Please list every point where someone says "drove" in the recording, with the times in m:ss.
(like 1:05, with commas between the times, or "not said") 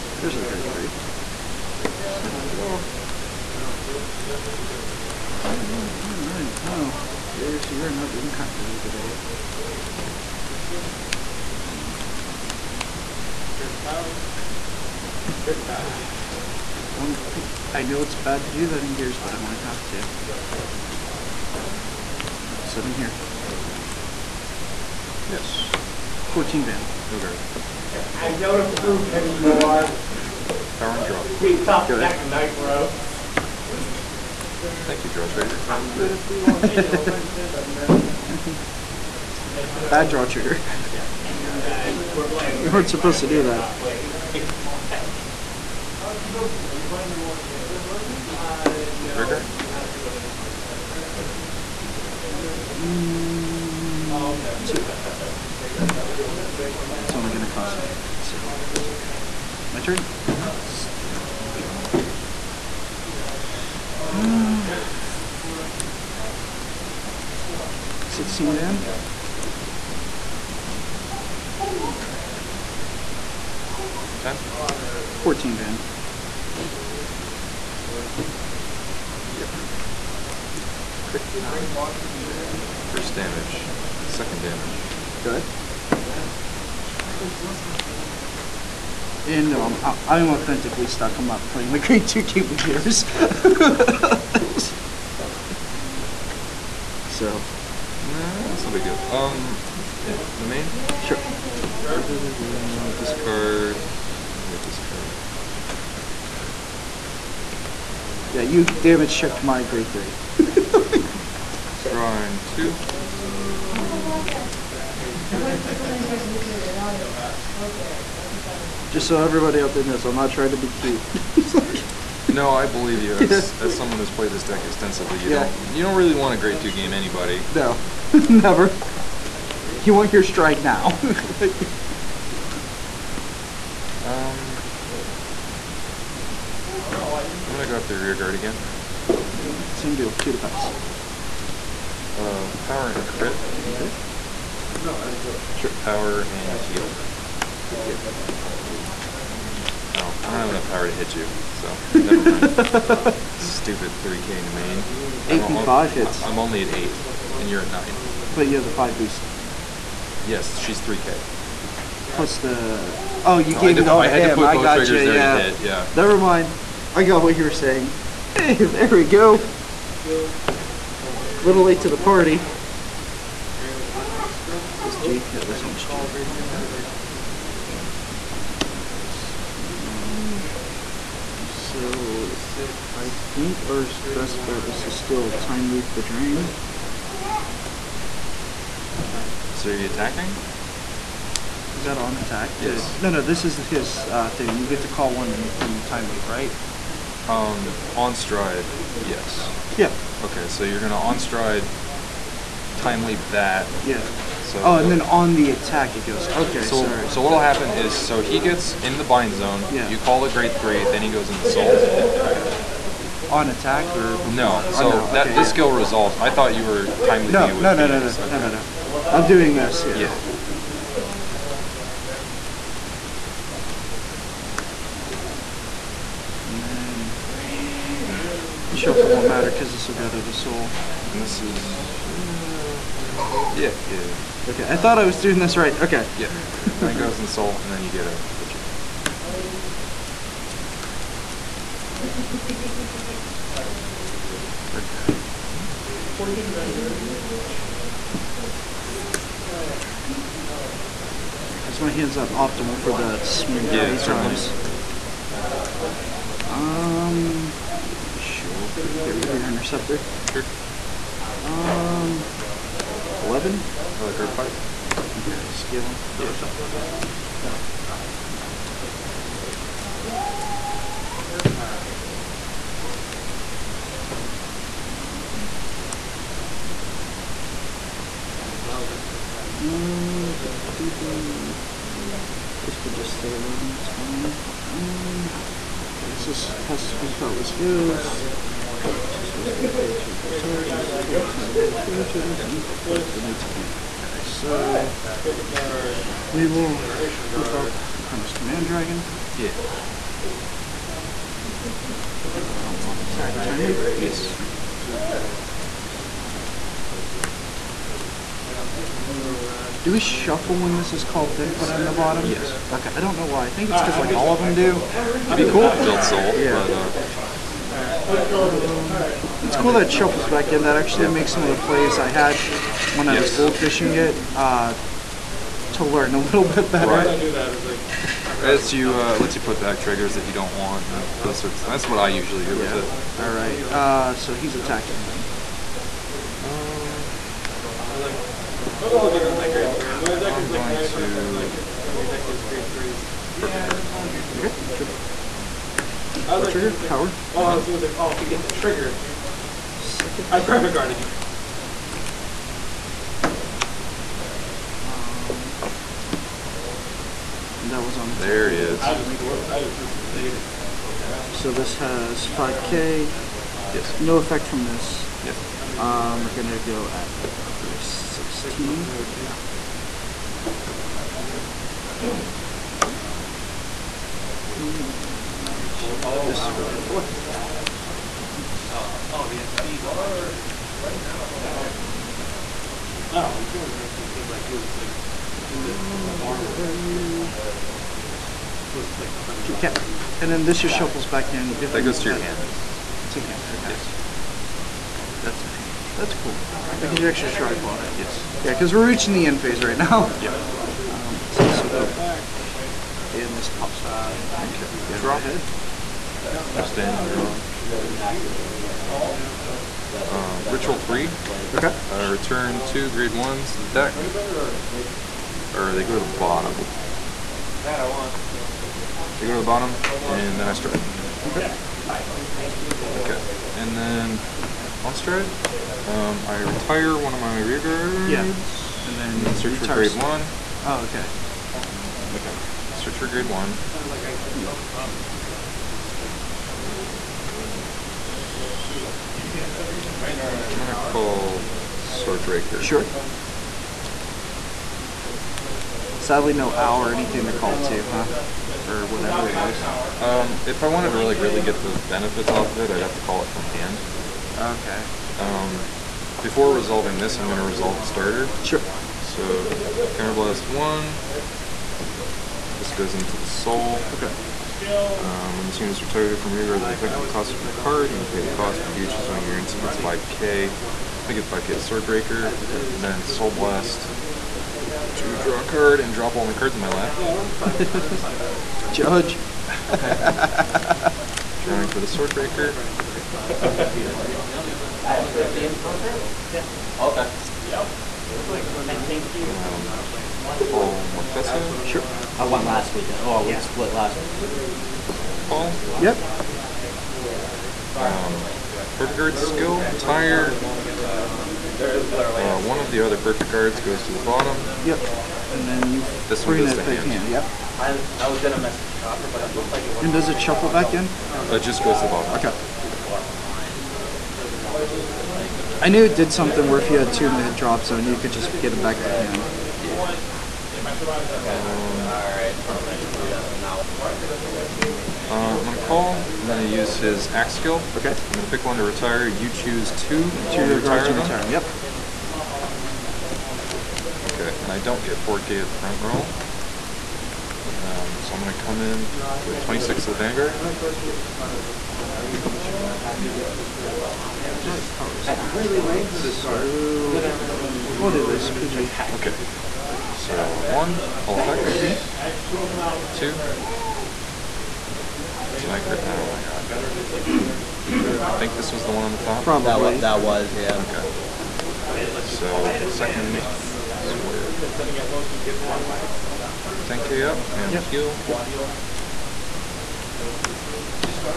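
2:25.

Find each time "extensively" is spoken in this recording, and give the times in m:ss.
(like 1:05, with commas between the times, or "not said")
2:04.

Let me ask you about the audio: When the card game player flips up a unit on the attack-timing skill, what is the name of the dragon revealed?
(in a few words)
Chronoscommand Dragon.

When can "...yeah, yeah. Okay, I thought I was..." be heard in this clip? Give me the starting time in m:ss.
3:53.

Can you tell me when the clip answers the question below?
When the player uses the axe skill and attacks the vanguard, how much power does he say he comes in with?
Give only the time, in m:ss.
8:59.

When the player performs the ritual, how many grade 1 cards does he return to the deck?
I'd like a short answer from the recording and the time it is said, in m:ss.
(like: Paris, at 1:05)
2, at 6:52.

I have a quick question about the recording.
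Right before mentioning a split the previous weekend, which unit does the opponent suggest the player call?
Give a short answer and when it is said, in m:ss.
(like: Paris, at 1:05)
Morfessa, at 8:10.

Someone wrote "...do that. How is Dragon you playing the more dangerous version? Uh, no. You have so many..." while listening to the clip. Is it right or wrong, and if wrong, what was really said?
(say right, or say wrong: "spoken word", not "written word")
wrong: "Are", not "Dragon".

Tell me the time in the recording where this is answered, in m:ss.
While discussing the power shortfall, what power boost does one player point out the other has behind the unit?
2:38.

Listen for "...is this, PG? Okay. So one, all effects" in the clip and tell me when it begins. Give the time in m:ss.
9:07.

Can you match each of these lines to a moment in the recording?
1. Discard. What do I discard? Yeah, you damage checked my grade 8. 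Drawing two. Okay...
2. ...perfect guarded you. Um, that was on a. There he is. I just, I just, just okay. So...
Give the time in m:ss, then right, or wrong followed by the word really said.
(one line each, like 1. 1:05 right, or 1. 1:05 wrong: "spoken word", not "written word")
1. 1:42 wrong: "3", not "8"
2. 5:50 right.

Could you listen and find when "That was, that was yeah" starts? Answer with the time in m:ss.
9:19.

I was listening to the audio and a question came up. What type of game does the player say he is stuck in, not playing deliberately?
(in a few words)
grade 2 game.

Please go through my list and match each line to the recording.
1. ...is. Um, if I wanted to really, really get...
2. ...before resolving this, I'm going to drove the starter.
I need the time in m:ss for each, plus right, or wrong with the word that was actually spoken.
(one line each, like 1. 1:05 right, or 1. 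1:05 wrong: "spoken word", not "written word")
1. 7:29 right
2. 7:36 wrong: "resolve", not "drove".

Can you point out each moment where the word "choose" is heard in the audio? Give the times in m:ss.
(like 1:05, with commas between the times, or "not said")
7:48, 8:49.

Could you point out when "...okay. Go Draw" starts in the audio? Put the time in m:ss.
6:44.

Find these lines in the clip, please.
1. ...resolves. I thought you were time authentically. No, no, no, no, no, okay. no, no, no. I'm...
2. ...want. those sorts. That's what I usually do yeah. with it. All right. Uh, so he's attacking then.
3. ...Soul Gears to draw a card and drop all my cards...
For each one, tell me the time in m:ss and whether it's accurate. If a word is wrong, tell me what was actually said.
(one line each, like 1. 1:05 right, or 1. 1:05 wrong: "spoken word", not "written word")
1. 3:35 wrong: "timely", not "authentically"
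2. 5:30 right
3. 7:53 wrong: "Blast", not "Gears".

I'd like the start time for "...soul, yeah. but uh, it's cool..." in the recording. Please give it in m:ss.
5:16.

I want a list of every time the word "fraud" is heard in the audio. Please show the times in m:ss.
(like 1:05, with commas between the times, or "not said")
not said.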